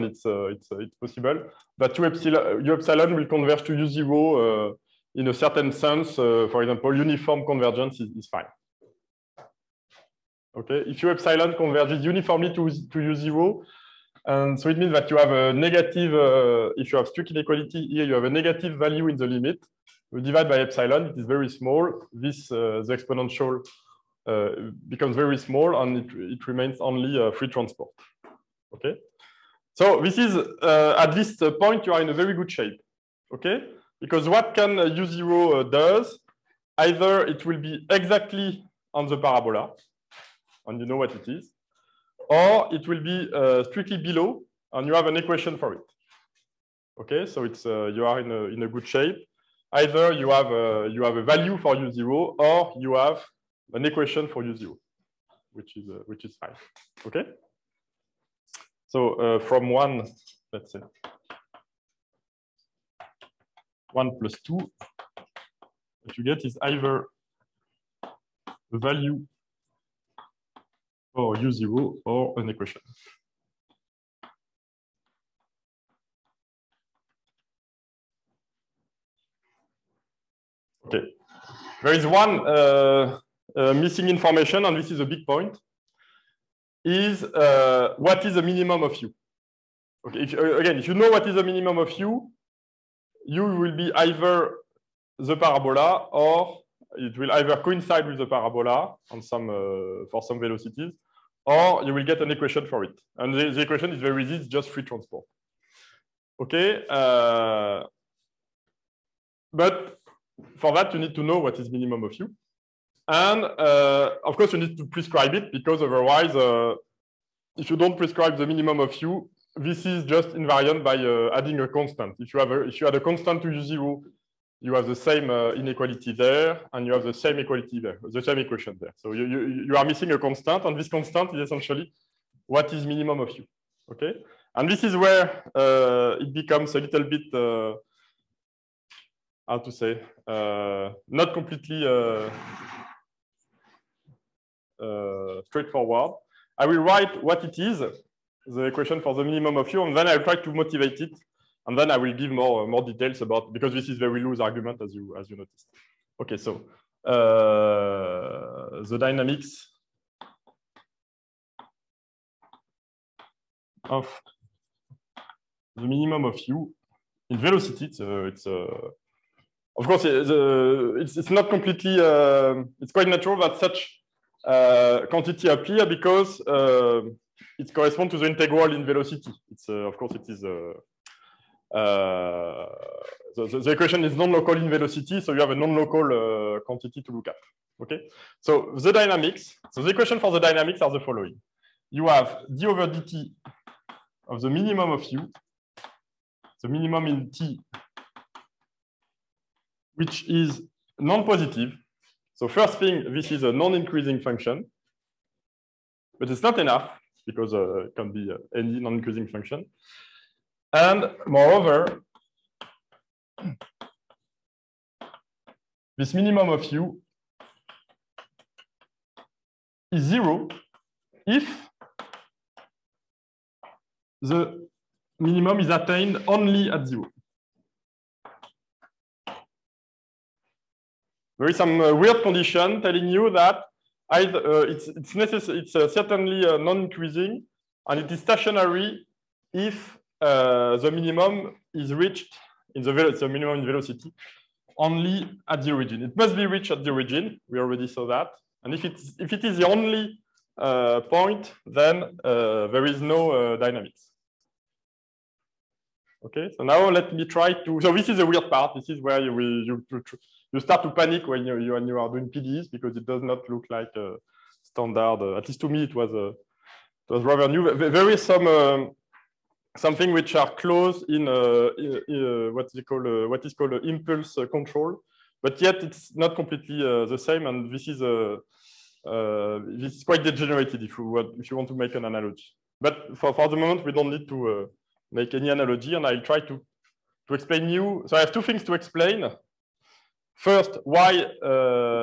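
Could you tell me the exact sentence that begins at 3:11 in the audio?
You have d over dt of the minimum of u, the minimum in t, which is non-positive.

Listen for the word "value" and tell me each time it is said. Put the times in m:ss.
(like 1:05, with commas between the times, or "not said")
0:18, 0:51, 1:08.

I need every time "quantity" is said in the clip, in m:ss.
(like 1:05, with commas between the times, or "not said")
2:55, 3:06.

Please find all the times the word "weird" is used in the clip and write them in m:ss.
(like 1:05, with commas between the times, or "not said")
3:51, 4:18.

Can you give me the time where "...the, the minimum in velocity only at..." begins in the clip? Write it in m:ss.
4:02.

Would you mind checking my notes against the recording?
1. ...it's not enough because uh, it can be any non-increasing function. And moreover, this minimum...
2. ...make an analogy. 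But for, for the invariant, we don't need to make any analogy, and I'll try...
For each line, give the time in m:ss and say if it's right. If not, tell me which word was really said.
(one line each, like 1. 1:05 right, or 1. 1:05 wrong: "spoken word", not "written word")
1. 3:26 right
2. 4:41 wrong: "moment", not "invariant".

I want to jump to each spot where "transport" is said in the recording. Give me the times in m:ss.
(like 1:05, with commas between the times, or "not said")
0:27, 1:44.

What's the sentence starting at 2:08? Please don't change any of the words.
So you, you, you are missing a constant, and this constant is essentially what is minimum of u, okay?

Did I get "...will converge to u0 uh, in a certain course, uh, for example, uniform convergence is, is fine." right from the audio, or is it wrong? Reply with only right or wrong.
wrong.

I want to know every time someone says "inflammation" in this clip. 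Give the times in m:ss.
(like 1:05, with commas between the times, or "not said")
not said.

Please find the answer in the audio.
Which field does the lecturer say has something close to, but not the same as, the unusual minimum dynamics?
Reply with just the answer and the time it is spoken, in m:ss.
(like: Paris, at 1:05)
Impulse control, at 4:33.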